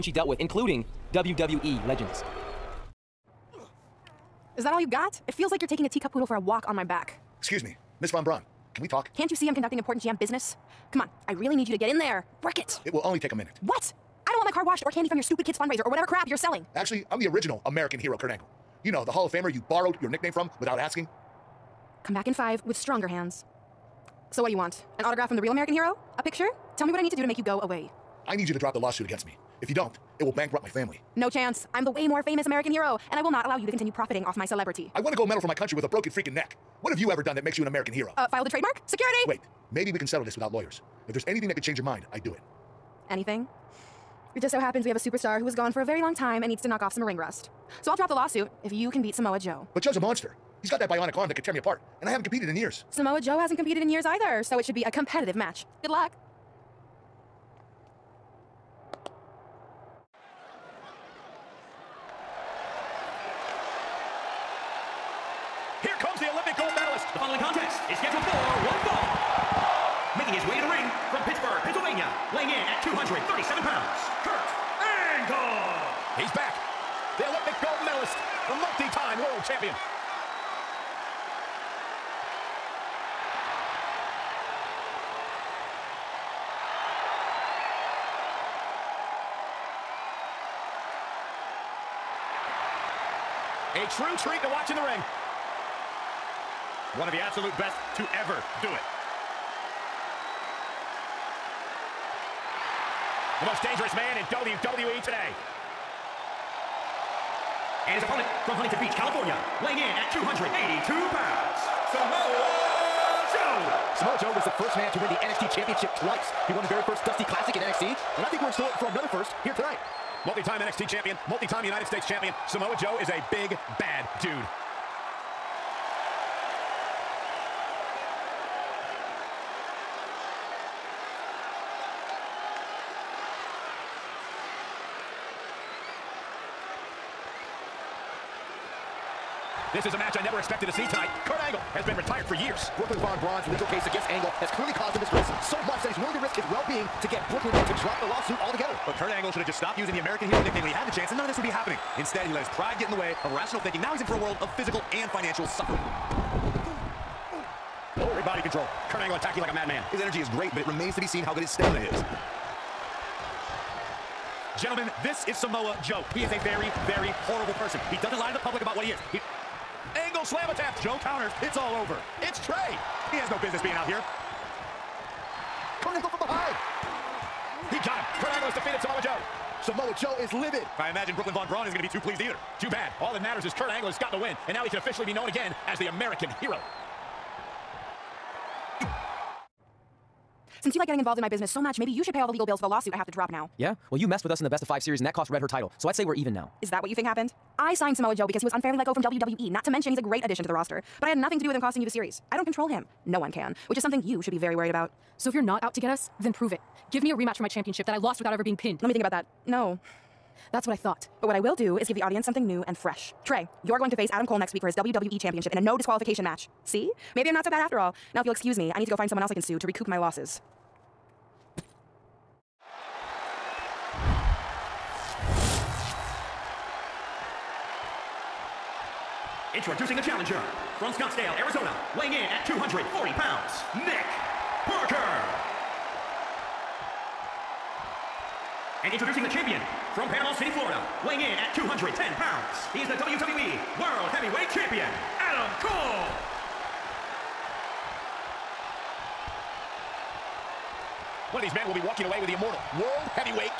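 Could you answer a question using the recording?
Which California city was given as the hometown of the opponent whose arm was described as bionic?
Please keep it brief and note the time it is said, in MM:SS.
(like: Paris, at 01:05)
Huntington Beach, at 01:48.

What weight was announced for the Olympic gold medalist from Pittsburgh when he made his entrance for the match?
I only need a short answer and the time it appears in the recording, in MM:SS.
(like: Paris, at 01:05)
237 pounds, at 01:12.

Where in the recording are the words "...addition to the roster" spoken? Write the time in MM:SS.
03:20.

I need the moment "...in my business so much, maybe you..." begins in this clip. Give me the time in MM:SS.
03:11.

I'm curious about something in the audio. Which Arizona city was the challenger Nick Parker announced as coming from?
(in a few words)
Scottsdale.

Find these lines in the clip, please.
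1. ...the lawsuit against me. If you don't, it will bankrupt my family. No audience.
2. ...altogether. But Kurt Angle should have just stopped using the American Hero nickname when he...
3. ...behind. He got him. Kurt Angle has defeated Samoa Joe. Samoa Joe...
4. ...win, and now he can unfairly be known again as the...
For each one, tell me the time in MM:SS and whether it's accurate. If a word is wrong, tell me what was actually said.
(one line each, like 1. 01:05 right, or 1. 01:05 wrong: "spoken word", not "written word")
1. 00:28 wrong: "chance", not "audience"
2. 02:28 right
3. 02:56 right
4. 03:04 wrong: "officially", not "unfairly".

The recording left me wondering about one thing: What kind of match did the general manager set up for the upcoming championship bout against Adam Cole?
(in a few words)
No disqualification.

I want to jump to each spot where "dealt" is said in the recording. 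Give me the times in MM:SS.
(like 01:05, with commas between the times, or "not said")
00:00.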